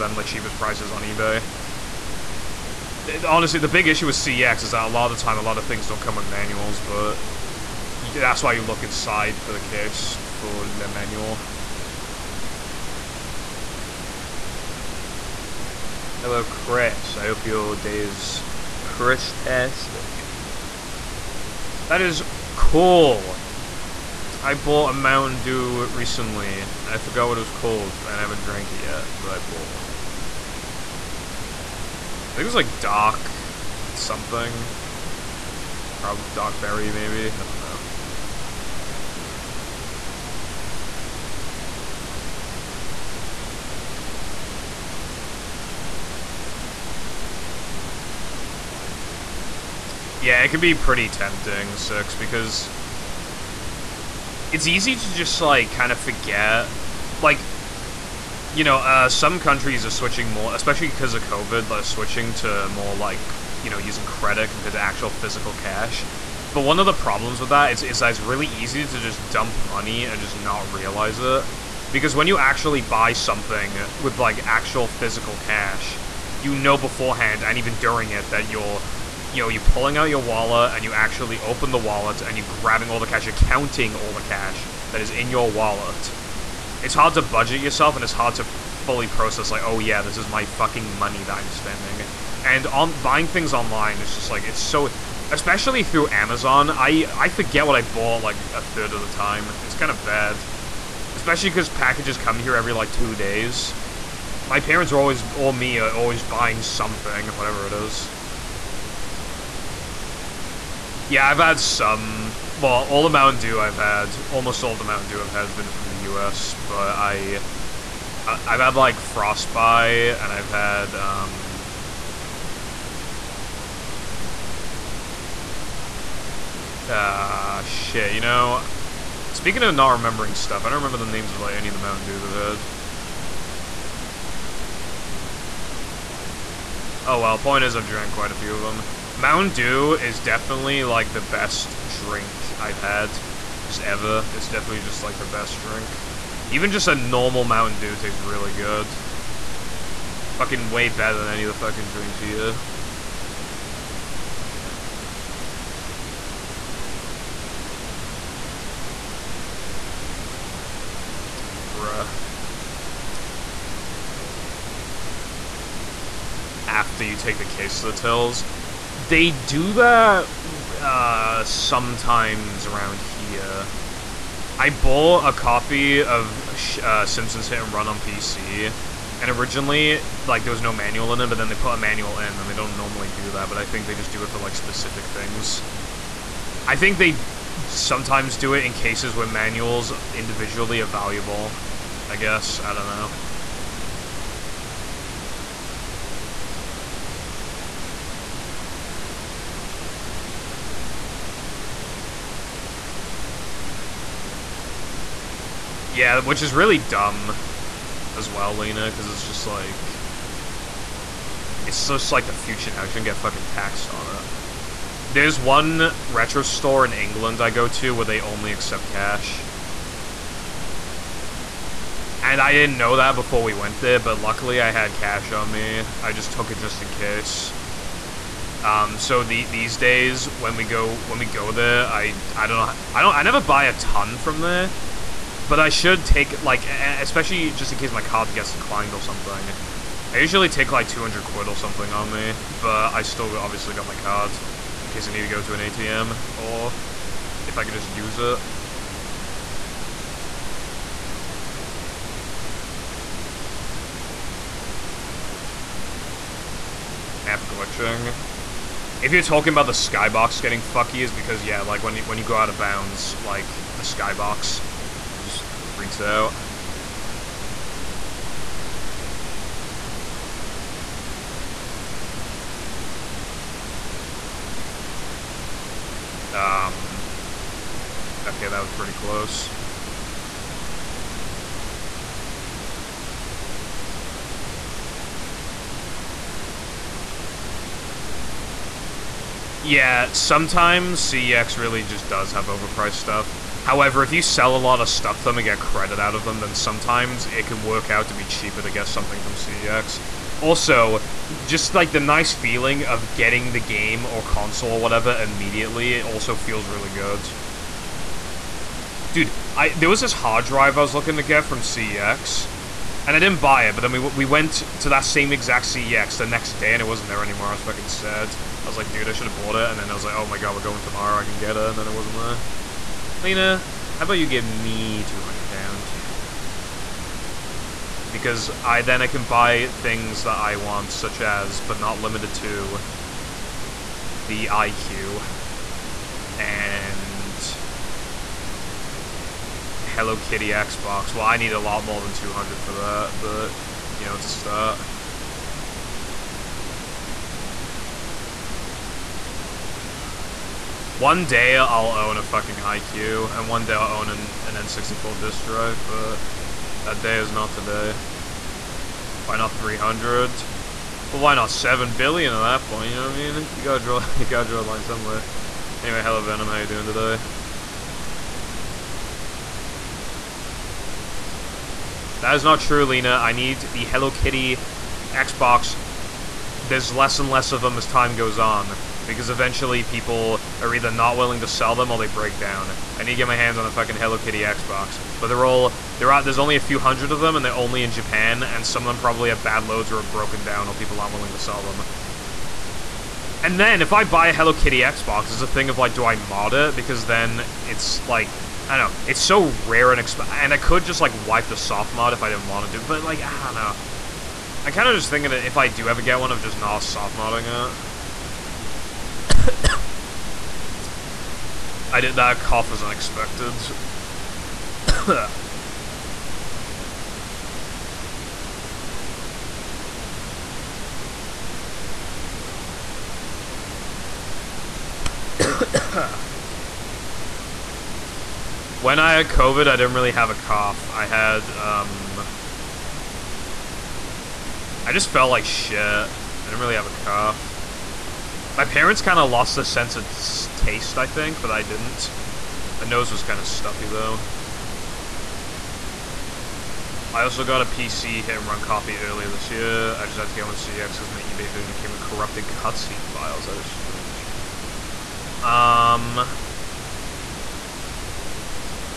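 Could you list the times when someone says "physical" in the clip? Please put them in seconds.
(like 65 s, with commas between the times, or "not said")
65 s, 74 s.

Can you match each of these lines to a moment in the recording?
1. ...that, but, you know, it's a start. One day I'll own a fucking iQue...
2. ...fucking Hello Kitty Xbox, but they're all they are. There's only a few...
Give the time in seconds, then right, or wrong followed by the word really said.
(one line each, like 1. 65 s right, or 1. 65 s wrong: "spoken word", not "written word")
1. 342 s right
2. 383 s right.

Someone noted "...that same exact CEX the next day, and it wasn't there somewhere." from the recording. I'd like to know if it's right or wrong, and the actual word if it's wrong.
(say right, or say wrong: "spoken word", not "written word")
wrong: "anymore", not "somewhere".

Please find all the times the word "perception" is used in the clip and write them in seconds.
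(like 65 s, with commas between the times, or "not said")
not said.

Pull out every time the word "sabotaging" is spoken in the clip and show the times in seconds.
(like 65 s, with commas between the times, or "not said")
not said.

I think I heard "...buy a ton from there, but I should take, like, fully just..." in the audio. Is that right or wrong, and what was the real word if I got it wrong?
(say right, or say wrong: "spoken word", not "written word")
wrong: "especially", not "fully".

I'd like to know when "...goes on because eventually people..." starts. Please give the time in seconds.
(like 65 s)
378 s.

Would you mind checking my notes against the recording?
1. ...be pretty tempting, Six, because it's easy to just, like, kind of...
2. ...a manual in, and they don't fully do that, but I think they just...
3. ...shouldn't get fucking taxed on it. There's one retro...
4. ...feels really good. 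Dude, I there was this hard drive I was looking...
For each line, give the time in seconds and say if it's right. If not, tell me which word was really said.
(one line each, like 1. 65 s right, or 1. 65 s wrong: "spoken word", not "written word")
1. 50 s right
2. 181 s wrong: "normally", not "fully"
3. 212 s right
4. 306 s right.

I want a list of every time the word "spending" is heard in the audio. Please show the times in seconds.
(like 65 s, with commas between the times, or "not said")
91 s.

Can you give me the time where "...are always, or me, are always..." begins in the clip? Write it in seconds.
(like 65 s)
104 s.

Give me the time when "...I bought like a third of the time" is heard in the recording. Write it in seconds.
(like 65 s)
97 s.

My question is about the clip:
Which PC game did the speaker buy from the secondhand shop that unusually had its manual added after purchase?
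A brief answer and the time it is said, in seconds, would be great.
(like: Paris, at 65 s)
Simpsons Hit and Run, at 177 s.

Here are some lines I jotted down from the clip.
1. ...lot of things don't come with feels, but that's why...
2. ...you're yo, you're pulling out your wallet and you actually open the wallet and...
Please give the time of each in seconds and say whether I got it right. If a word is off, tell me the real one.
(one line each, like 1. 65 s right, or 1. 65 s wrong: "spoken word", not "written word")
1. 5 s wrong: "manuals", not "feels"
2. 78 s right.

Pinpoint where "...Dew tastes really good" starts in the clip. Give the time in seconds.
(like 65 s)
147 s.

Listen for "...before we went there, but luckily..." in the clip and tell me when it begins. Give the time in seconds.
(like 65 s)
223 s.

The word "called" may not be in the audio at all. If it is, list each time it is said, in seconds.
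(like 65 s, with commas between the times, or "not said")
27 s.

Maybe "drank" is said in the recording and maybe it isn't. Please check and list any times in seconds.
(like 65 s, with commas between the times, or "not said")
28 s, 137 s.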